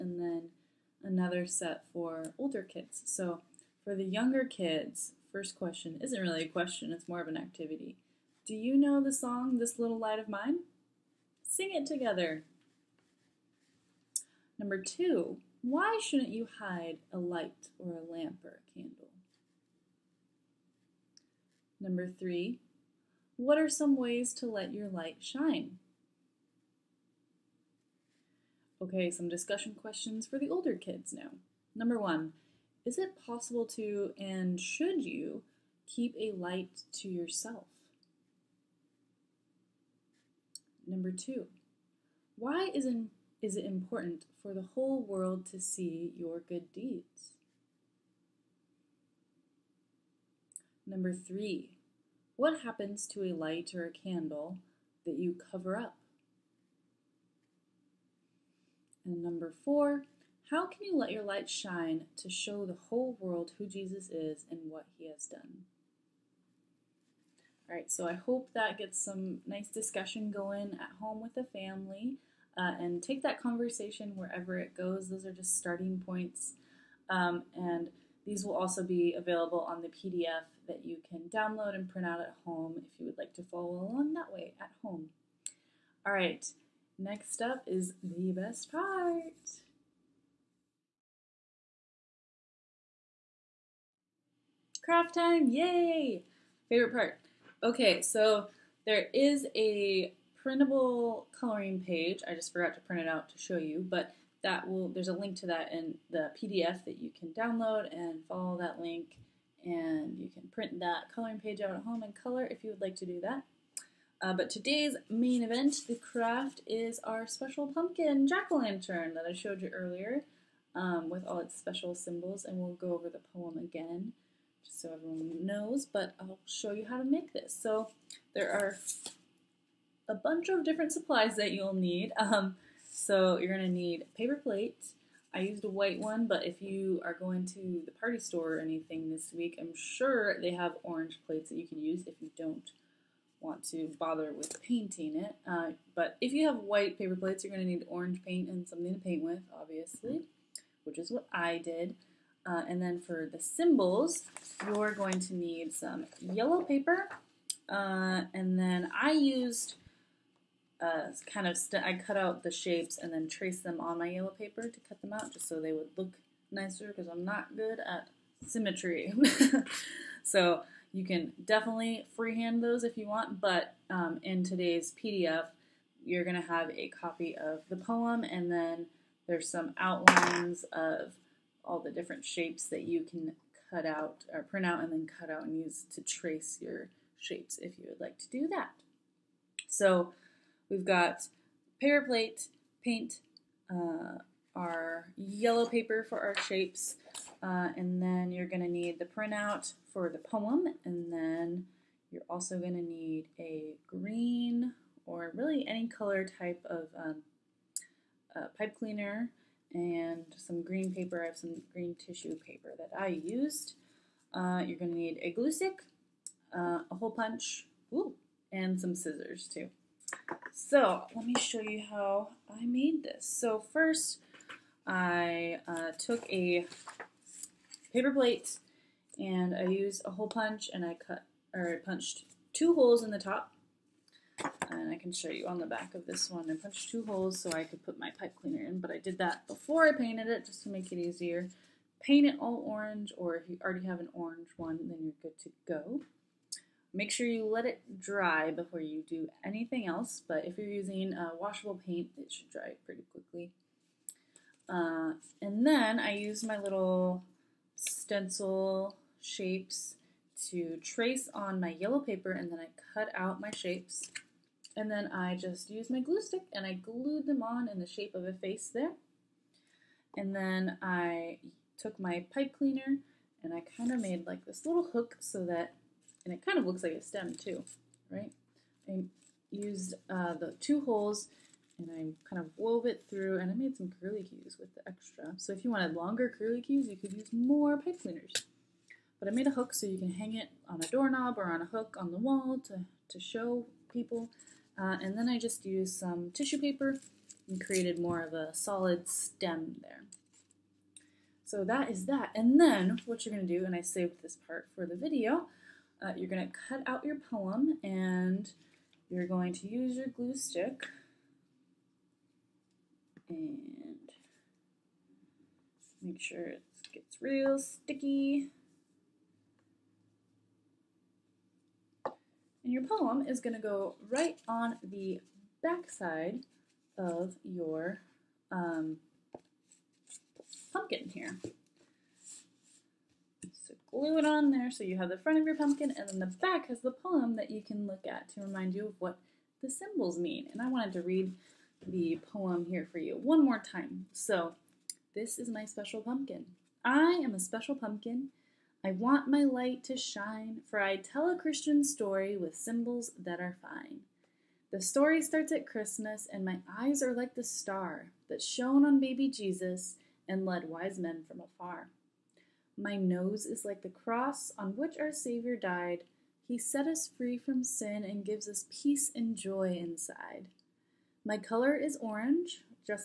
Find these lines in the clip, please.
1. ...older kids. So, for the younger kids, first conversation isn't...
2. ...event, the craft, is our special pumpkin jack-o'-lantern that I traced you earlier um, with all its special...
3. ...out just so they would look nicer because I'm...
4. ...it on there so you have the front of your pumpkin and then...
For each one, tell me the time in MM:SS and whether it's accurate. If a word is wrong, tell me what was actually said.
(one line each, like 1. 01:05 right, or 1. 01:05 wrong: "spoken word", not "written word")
1. 00:02 wrong: "question", not "conversation"
2. 01:55 wrong: "showed", not "traced"
3. 02:45 right
4. 05:34 right.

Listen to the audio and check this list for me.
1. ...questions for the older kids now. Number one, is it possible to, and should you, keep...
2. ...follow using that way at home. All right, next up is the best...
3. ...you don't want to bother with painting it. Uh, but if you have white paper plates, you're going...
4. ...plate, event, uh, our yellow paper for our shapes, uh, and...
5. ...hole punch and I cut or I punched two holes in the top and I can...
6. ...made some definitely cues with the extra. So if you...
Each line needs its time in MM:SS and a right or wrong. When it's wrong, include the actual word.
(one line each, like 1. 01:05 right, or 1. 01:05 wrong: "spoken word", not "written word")
1. 00:29 right
2. 01:23 wrong: "along", not "using"
3. 02:22 right
4. 03:12 wrong: "paint", not "event"
5. 03:50 right
6. 04:43 wrong: "curly", not "definitely".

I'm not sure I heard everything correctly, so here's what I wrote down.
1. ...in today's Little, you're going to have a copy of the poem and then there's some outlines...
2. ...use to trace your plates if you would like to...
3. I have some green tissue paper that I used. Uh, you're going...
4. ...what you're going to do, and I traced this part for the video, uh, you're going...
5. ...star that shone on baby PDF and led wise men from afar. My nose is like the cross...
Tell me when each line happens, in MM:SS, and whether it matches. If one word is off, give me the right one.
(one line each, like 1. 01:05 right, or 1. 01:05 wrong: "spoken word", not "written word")
1. 02:54 wrong: "PDF", not "Little"
2. 03:05 wrong: "shapes", not "plates"
3. 03:31 right
4. 05:03 wrong: "saved", not "traced"
5. 05:57 wrong: "Jesus", not "PDF".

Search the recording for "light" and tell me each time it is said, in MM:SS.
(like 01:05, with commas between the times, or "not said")
00:09, 00:17, 00:24, 00:36, 00:53, 01:01, 05:49.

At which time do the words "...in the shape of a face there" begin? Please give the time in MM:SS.
04:27.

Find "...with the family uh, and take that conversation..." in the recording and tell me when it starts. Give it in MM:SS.
01:11.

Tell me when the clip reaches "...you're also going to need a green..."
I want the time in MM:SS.
03:22.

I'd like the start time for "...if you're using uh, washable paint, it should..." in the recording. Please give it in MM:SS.
04:10.